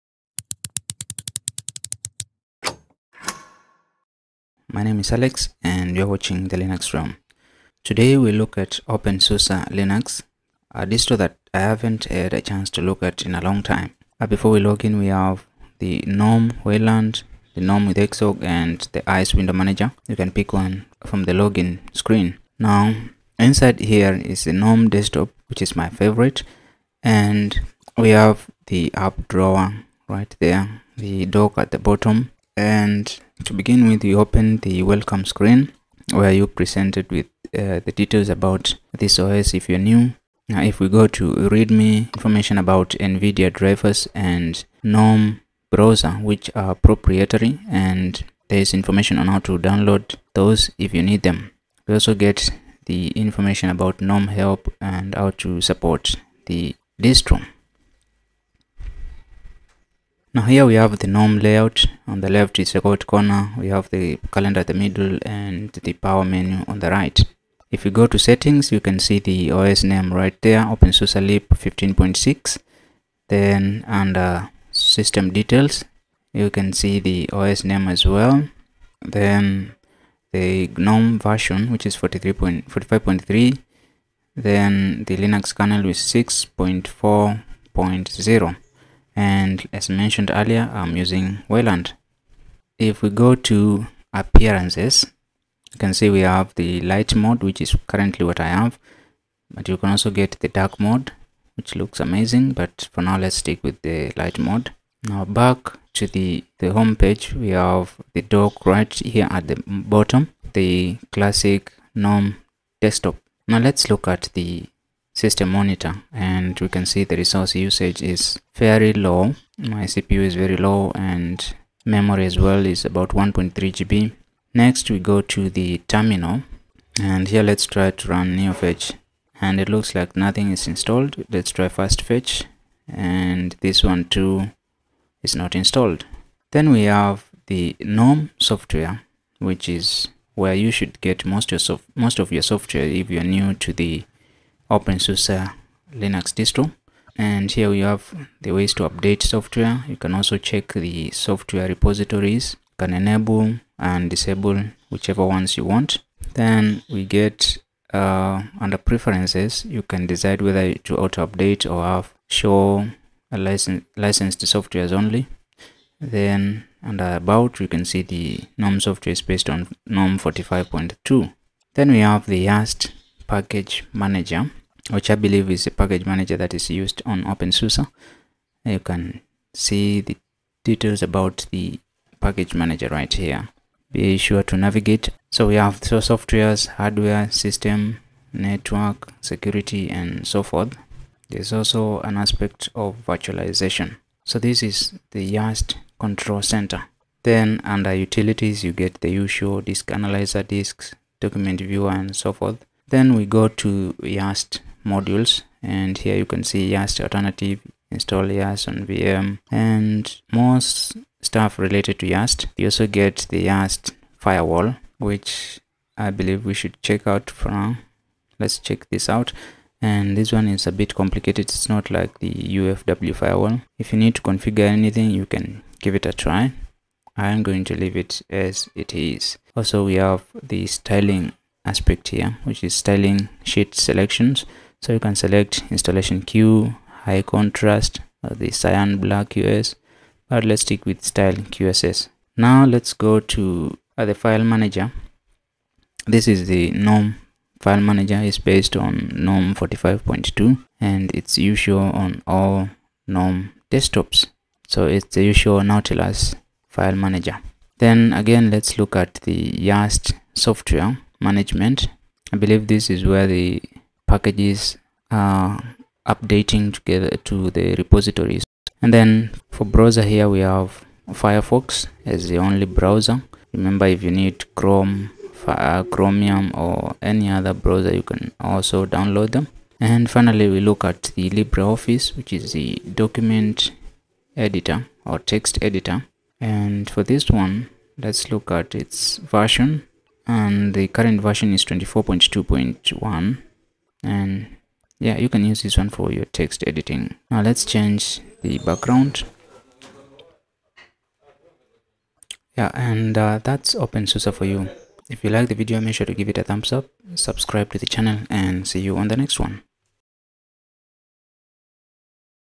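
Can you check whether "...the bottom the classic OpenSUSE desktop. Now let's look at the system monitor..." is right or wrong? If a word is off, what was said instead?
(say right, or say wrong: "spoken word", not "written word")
wrong: "GNOME", not "OpenSUSE".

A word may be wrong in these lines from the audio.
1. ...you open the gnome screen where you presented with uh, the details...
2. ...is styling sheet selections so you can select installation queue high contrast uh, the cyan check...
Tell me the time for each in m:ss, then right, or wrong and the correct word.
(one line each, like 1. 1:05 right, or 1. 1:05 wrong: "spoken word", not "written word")
1. 0:34 wrong: "welcome", not "gnome"
2. 3:52 wrong: "black", not "check".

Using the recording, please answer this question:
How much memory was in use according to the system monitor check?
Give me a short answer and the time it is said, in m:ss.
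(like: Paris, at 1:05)
1.3 GB, at 2:03.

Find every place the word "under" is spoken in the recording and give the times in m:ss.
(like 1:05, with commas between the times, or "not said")
1:13, 2:38, 2:46, 3:17.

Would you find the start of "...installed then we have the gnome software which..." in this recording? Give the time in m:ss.
2:15.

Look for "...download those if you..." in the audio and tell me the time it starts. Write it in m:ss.
0:49.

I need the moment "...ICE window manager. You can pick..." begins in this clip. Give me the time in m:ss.
0:19.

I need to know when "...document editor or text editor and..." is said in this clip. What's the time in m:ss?
4:43.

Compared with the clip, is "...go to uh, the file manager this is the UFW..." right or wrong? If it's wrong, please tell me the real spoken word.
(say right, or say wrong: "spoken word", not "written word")
wrong: "GNOME", not "UFW".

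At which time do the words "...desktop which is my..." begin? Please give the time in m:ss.
0:24.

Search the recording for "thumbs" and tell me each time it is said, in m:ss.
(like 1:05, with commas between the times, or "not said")
5:06.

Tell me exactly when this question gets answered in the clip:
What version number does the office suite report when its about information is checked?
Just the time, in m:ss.
4:51.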